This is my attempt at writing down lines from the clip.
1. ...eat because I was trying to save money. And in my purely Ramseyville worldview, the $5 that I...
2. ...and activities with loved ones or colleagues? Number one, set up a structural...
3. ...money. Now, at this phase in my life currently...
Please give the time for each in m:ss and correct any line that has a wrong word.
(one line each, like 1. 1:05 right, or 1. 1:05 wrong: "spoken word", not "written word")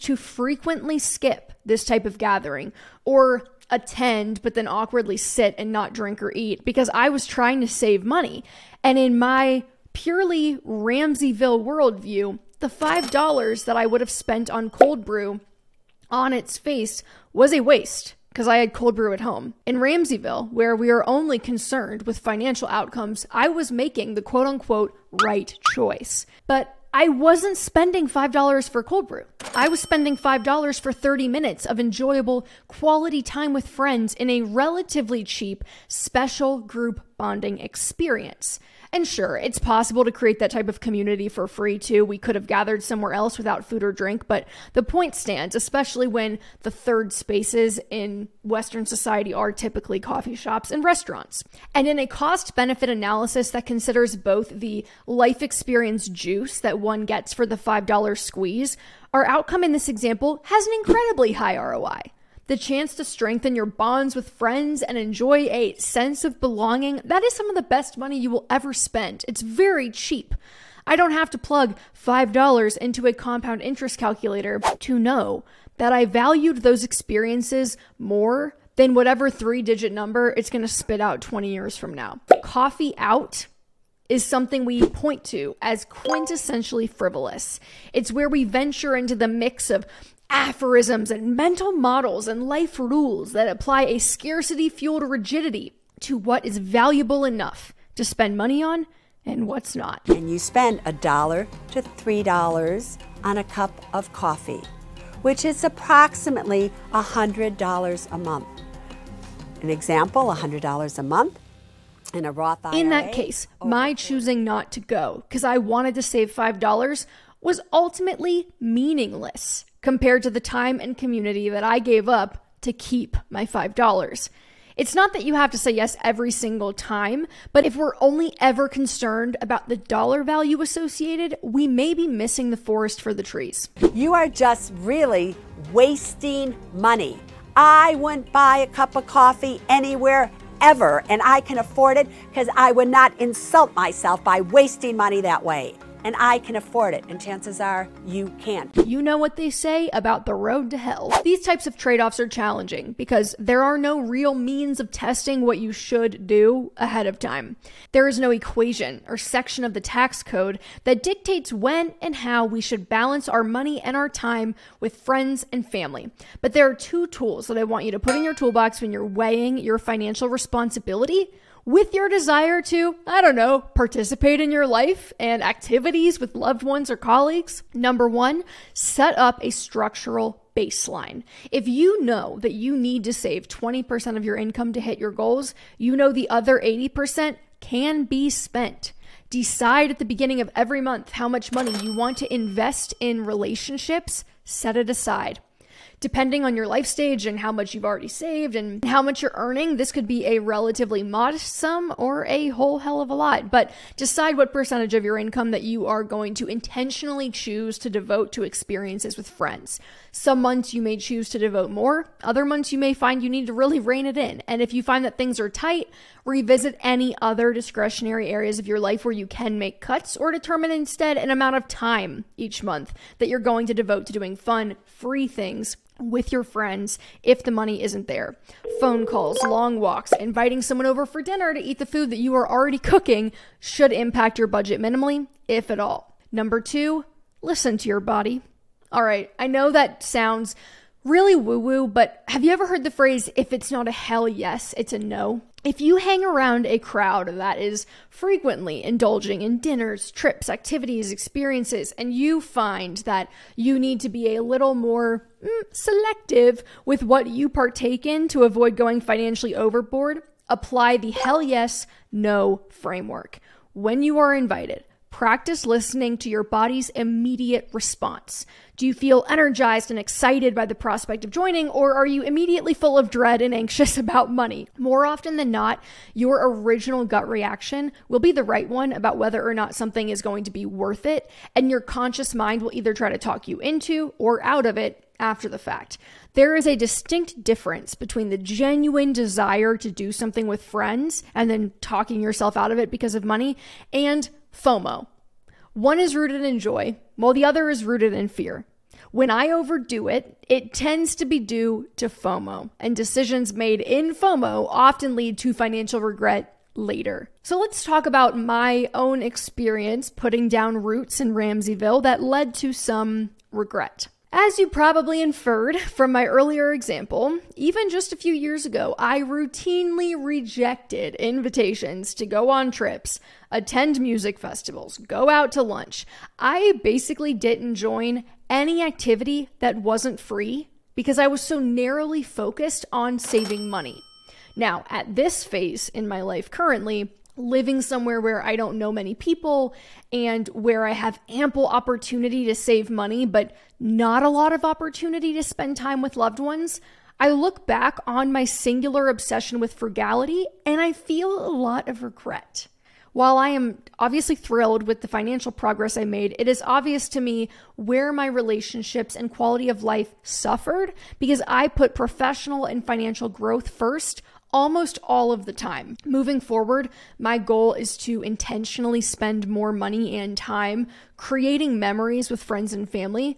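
1. 0:06 right
2. 2:55 right
3. 5:33 right.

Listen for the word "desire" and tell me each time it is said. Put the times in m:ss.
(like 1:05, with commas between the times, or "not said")
2:52, 4:49.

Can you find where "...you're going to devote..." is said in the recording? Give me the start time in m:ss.
3:43.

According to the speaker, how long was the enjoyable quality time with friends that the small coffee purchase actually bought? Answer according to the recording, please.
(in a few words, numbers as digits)
30 minutes.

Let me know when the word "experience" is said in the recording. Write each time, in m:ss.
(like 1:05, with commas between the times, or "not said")
0:37, 0:55, 1:16, 3:28, 4:11, 5:09.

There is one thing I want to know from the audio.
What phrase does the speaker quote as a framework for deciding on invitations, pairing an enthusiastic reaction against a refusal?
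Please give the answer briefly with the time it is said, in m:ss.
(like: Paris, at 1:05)
If it's not a hell yes, it's a no, at 4:03.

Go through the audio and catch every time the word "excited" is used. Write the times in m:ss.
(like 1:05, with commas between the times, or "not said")
4:29.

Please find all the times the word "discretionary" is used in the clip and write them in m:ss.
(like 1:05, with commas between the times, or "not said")
3:37.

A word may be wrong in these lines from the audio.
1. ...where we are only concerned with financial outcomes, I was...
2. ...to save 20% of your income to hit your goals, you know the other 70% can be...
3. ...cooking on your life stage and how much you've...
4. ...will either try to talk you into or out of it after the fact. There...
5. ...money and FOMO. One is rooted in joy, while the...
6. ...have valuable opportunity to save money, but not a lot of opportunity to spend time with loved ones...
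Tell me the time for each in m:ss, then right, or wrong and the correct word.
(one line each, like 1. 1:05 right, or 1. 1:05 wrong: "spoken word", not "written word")
1. 0:20 right
2. 3:03 wrong: "80", not "70"
3. 3:16 wrong: "depending", not "cooking"
4. 4:42 right
5. 4:53 right
6. 5:40 wrong: "ample", not "valuable".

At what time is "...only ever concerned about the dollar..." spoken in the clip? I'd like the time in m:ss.
2:07.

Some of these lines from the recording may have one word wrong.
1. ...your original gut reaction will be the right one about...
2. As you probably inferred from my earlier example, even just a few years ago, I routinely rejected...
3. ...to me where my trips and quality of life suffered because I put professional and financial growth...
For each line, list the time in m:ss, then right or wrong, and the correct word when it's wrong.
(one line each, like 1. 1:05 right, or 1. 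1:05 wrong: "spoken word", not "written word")
1. 4:36 right
2. 5:14 right
3. 5:57 wrong: "relationships", not "trips".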